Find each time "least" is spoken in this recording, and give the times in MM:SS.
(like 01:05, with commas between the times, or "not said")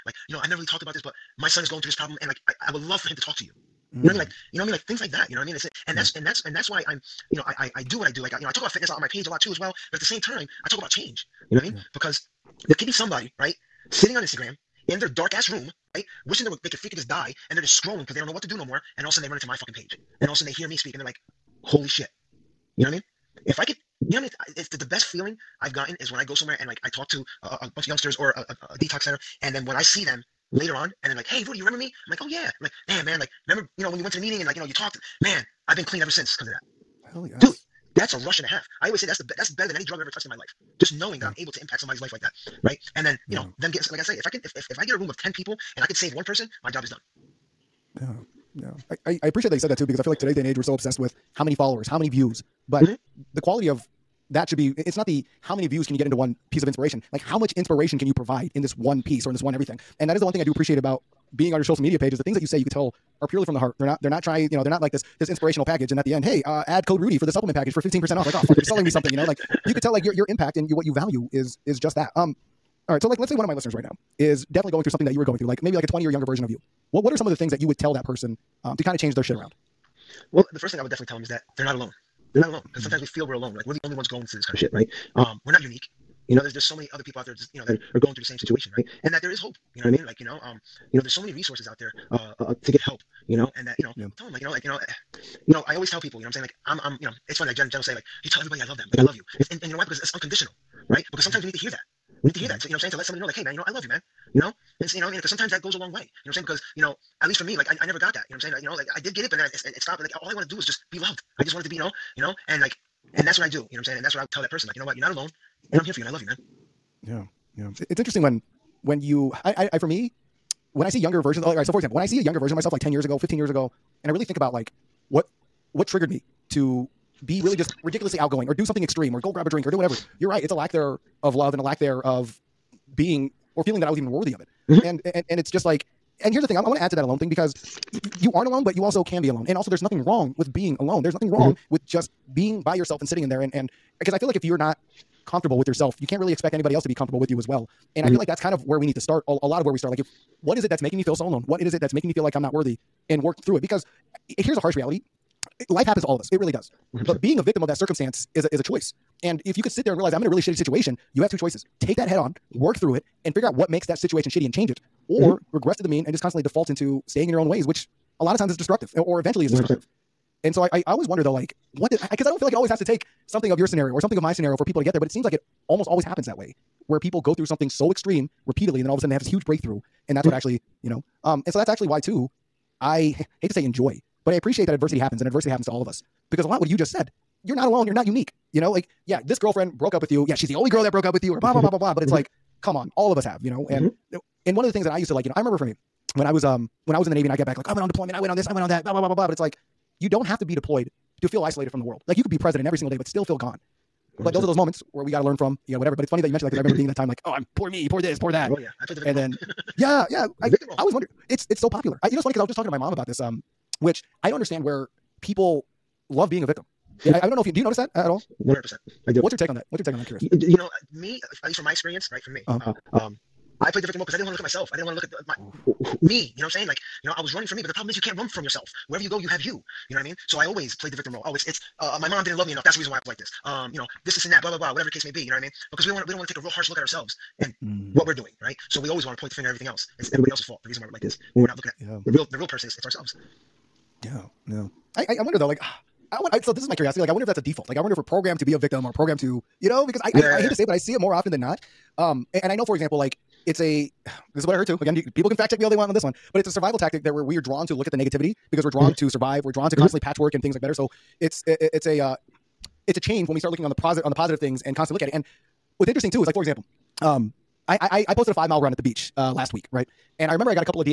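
01:47, 03:41.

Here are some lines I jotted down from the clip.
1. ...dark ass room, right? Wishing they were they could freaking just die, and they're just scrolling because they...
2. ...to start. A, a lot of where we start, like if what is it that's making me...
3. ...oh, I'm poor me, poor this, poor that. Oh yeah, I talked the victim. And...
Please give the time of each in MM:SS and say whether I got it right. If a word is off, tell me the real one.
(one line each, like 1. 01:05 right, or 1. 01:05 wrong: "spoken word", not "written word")
1. 00:15 right
2. 02:28 right
3. 03:27 wrong: "played", not "talked".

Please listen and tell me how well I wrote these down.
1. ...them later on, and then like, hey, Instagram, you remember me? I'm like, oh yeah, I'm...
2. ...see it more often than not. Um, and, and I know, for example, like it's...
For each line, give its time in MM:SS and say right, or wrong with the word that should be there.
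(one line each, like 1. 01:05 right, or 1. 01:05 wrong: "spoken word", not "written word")
1. 00:30 wrong: "Rudy", not "Instagram"
2. 04:10 right.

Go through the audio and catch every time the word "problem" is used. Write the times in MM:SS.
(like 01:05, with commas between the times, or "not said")
00:01, 03:47.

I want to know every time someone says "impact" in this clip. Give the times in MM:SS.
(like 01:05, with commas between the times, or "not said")
00:41, 01:10.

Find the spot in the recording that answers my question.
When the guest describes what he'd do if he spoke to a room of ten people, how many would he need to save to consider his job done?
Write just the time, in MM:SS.
00:46.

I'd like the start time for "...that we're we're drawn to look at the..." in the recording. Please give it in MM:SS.
04:17.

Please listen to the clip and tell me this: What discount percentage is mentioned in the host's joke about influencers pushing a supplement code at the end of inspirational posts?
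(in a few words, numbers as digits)
15%.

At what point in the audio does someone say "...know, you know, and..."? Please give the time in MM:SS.
01:51.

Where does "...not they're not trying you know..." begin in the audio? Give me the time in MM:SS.
01:03.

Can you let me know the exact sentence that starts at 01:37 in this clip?
Like Jen, Jen will say like, you tell everybody I love them, like I love you.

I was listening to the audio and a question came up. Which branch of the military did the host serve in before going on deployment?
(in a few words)
Navy.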